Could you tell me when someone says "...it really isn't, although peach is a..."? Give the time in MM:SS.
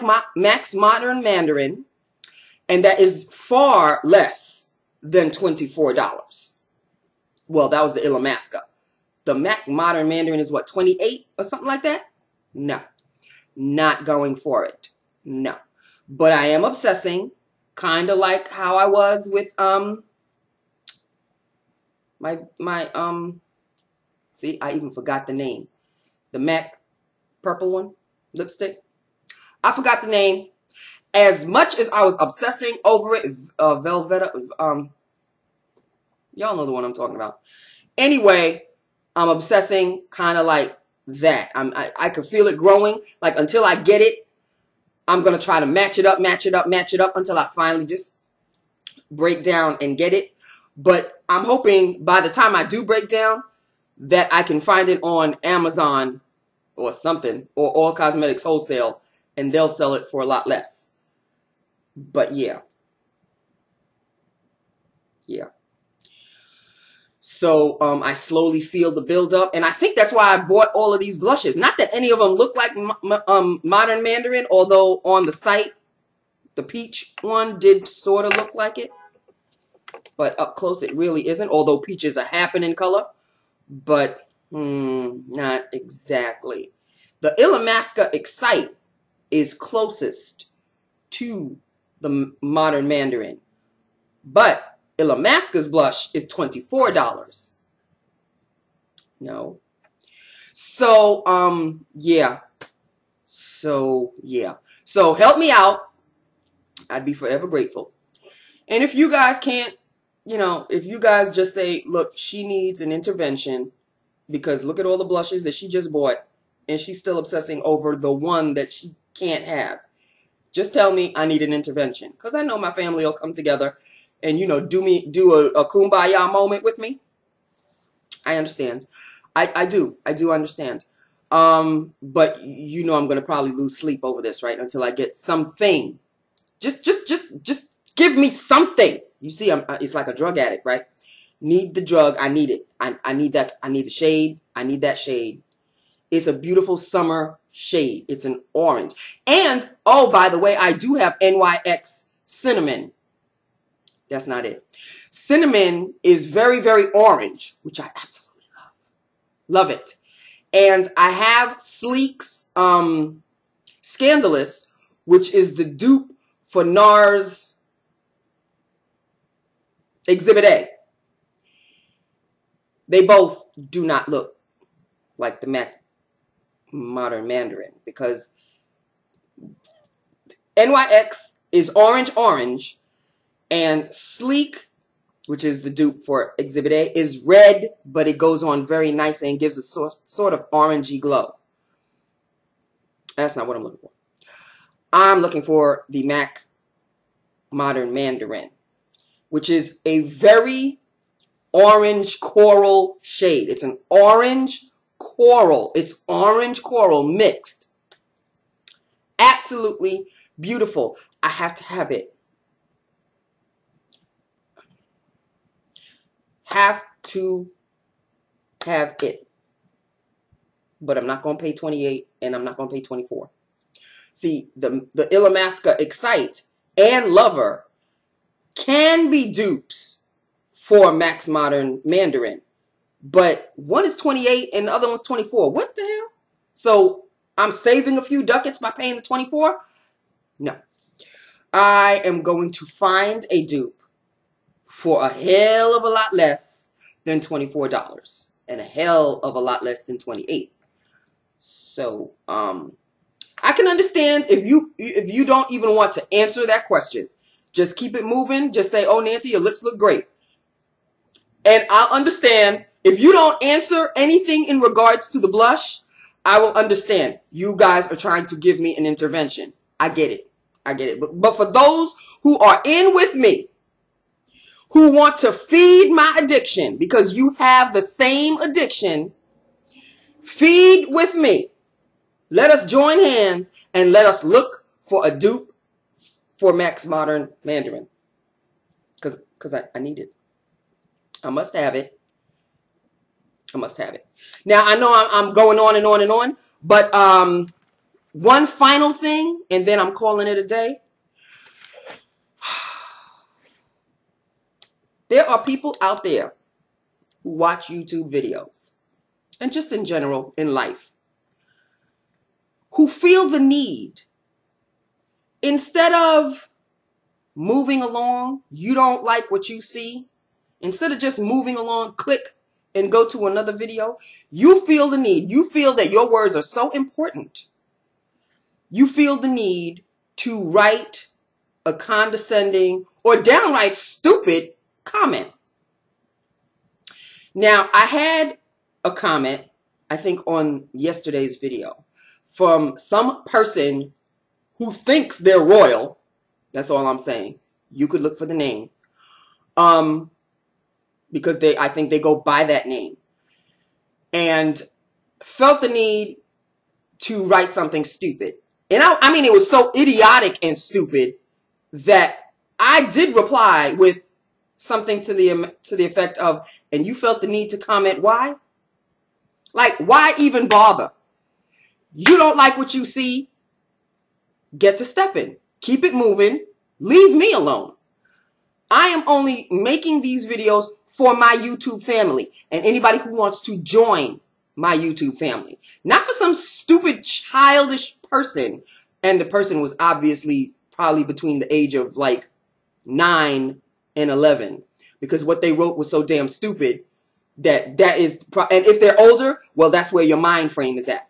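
01:20.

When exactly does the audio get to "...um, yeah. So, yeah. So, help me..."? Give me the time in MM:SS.
01:41.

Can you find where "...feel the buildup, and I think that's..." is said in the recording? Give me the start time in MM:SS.
01:08.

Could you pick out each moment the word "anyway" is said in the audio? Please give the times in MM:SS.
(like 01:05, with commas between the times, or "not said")
00:37.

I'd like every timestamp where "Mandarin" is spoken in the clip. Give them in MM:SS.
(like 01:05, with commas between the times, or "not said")
00:01, 00:10, 01:14, 01:32, 02:57, 03:17, 03:51, 04:47.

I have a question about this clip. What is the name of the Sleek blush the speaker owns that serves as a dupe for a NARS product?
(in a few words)
Scandalous.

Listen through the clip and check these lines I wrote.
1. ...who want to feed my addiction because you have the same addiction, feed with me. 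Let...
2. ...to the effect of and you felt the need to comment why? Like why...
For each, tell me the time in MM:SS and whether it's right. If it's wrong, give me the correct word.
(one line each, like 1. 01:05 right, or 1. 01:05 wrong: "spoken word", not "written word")
1. 04:34 right
2. 06:05 right.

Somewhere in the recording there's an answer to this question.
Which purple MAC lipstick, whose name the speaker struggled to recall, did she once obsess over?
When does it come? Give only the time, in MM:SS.
00:33.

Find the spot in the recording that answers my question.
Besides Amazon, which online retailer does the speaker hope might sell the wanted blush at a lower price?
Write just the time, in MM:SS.
00:57.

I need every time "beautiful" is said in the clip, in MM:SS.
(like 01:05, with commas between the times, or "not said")
02:26, 03:30.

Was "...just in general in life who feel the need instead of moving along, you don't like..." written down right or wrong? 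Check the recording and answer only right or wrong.
right.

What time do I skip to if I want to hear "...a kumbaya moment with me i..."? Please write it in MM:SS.
02:05.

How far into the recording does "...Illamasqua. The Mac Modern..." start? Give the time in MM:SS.
00:08.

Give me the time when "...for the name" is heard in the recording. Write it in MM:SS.
05:48.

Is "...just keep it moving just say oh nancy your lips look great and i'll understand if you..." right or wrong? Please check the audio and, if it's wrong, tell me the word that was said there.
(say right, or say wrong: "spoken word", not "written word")
right.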